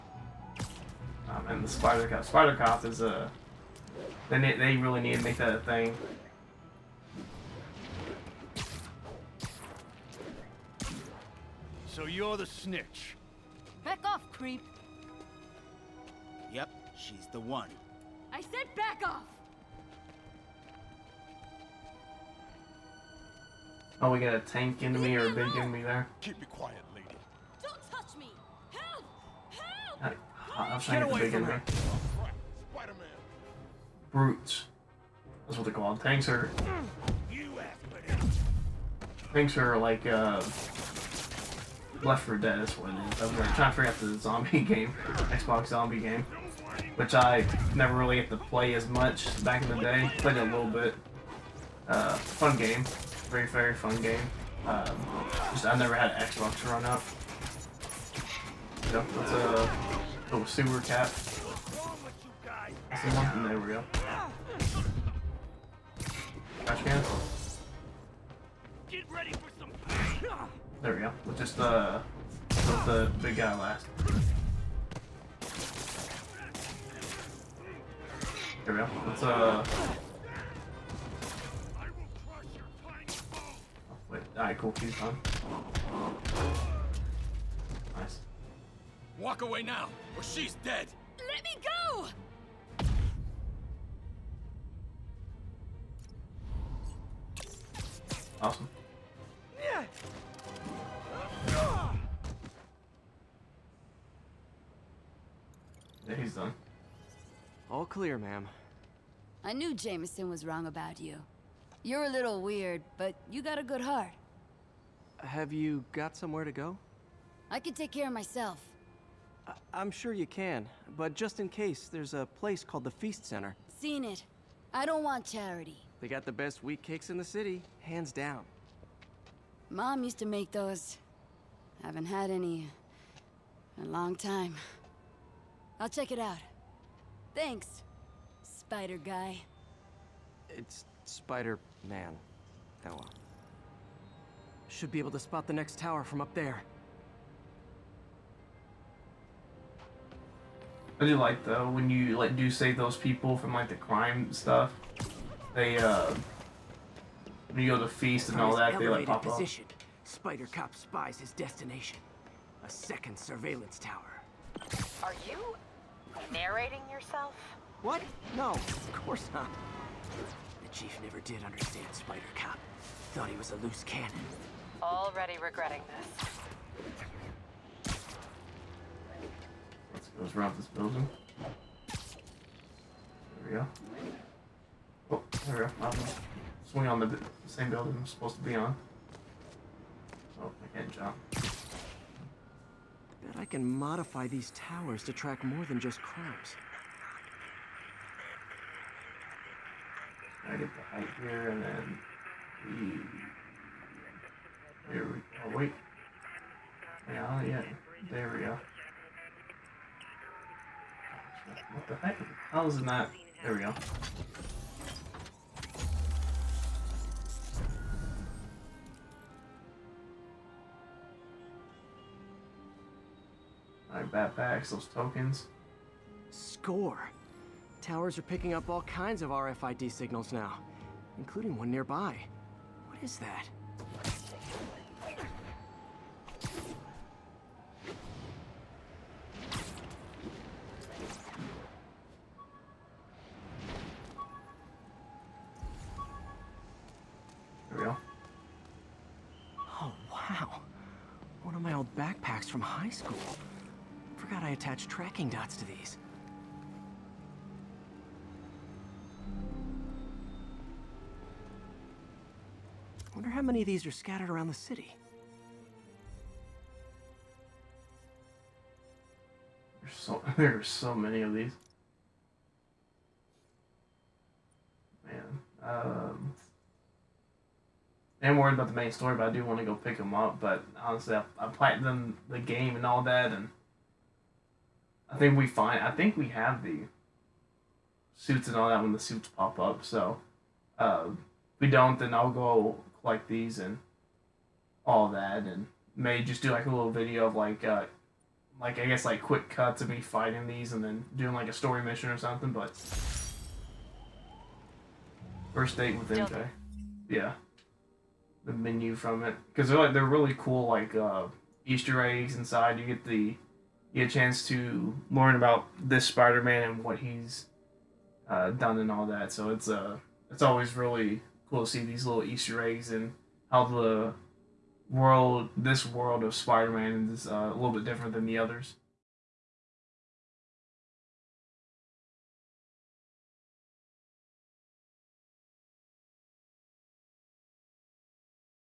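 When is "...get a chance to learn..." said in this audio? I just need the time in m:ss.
5:14.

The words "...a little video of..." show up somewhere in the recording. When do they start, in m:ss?
4:56.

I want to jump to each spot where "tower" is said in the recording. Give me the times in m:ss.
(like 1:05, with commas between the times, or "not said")
2:25, 2:43, 3:14, 3:47.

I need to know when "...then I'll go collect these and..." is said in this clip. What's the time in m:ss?
4:51.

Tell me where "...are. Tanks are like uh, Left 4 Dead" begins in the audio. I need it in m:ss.
0:36.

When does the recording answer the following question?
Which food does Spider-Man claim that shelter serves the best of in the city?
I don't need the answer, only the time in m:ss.
2:06.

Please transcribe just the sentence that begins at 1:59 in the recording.
I am sure you can, but just in case, there's a place called the Feast Center.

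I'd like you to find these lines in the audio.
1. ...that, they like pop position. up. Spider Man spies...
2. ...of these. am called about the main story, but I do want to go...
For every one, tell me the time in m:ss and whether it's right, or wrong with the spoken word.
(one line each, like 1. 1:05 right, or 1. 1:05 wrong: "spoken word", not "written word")
1. 2:38 wrong: "Cop", not "Man"
2. 4:31 wrong: "worried", not "called".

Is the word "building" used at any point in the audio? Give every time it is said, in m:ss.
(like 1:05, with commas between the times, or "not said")
3:00, 3:07.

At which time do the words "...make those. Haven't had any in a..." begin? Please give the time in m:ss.
2:10.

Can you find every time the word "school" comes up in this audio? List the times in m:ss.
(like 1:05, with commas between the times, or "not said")
4:12.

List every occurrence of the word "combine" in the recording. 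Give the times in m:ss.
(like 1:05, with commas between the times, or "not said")
not said.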